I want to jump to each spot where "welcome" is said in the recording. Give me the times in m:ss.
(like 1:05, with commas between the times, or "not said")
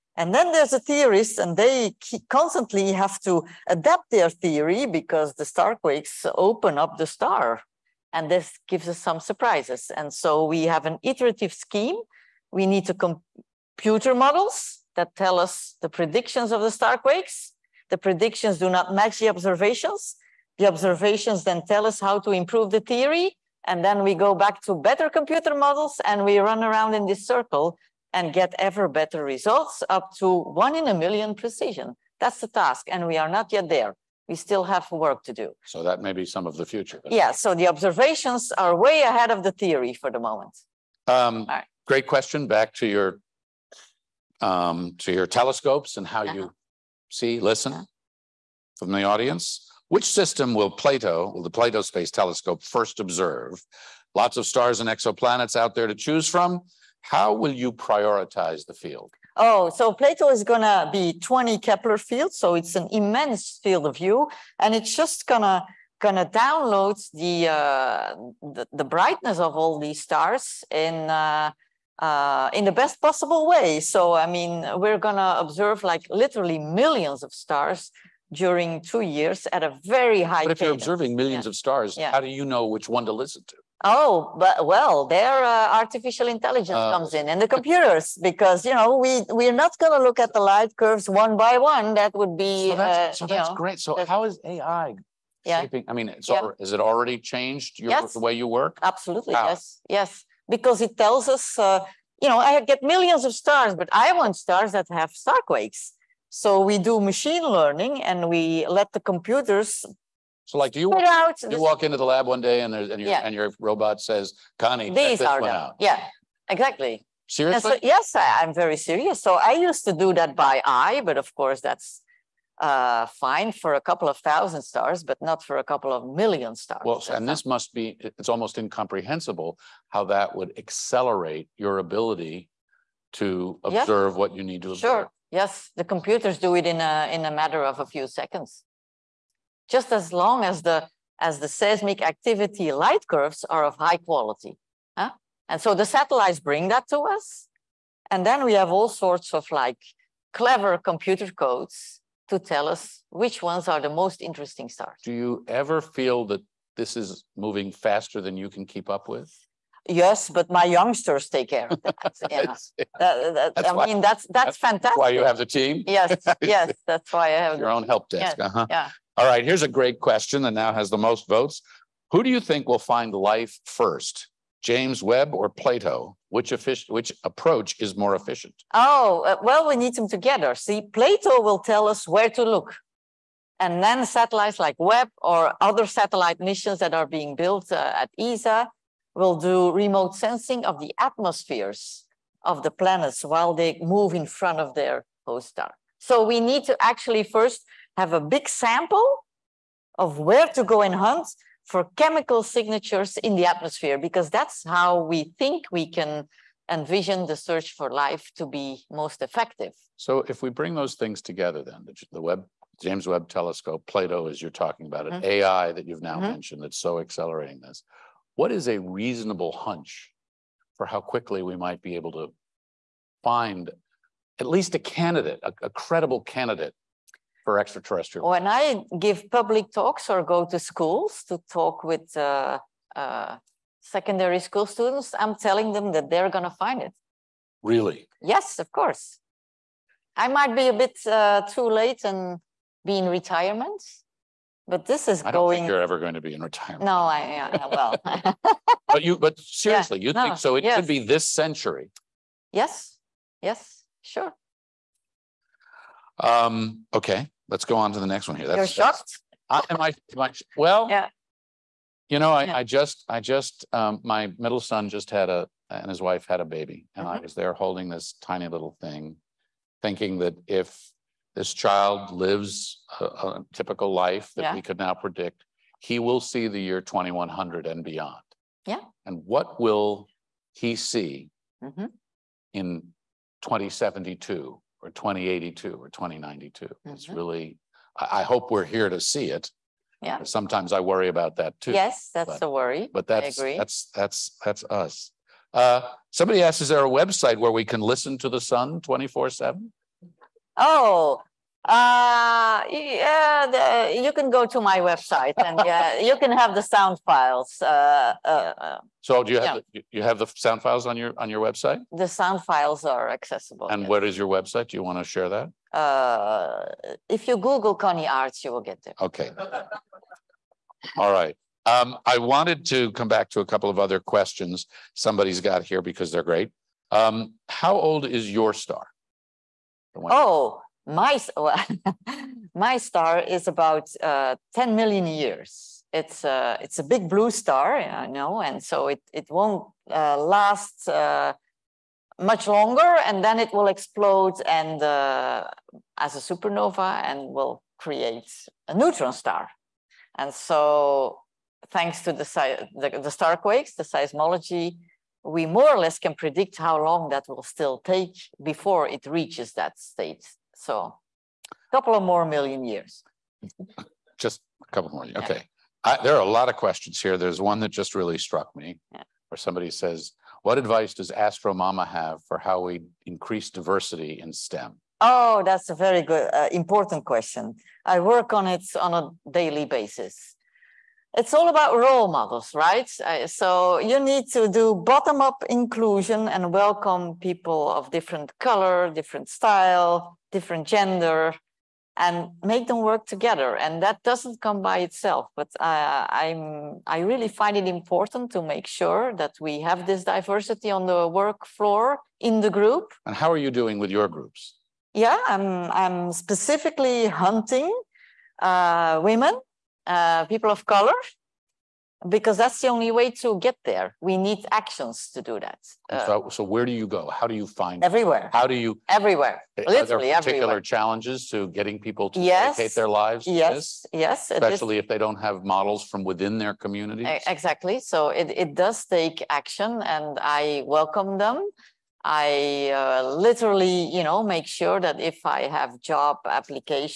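6:26, 7:10.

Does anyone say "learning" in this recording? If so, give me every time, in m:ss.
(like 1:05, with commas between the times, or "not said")
1:47.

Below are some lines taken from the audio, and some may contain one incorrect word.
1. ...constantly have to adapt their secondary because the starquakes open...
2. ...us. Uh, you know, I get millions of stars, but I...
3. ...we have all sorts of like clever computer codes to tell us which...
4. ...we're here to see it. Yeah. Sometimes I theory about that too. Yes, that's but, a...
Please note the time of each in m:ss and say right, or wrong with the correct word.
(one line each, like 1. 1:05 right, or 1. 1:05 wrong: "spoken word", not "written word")
1. 0:02 wrong: "theory", not "secondary"
2. 1:41 right
3. 2:28 right
4. 4:48 wrong: "worry", not "theory".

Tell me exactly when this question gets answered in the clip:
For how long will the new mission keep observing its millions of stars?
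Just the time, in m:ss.
1:18.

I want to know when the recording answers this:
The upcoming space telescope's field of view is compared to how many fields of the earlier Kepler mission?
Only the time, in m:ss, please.
1:01.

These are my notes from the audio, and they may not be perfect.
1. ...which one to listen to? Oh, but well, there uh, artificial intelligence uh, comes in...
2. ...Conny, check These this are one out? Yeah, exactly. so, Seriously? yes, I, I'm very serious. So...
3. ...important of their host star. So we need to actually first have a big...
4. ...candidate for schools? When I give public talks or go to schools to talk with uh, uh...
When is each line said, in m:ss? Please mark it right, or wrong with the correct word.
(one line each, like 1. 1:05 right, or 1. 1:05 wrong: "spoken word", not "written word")
1. 1:22 right
2. 1:54 right
3. 3:14 wrong: "front", not "important"
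4. 3:46 wrong: "extraterrestrials", not "schools".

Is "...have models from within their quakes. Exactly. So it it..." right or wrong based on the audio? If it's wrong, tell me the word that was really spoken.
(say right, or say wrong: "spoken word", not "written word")
wrong: "communities", not "quakes".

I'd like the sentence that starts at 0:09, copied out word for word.
And so we have an iterative scheme.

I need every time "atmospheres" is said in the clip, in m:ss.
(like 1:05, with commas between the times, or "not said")
3:10, 3:23.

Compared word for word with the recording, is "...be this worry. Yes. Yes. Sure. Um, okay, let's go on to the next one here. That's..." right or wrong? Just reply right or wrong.
wrong.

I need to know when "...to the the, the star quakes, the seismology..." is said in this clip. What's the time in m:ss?
5:52.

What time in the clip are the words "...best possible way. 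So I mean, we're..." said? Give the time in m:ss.
1:12.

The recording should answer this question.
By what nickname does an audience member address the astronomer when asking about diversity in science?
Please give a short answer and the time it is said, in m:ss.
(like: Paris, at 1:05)
Astro Mama, at 6:11.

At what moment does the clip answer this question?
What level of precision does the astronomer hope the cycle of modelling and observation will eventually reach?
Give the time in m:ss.
0:30.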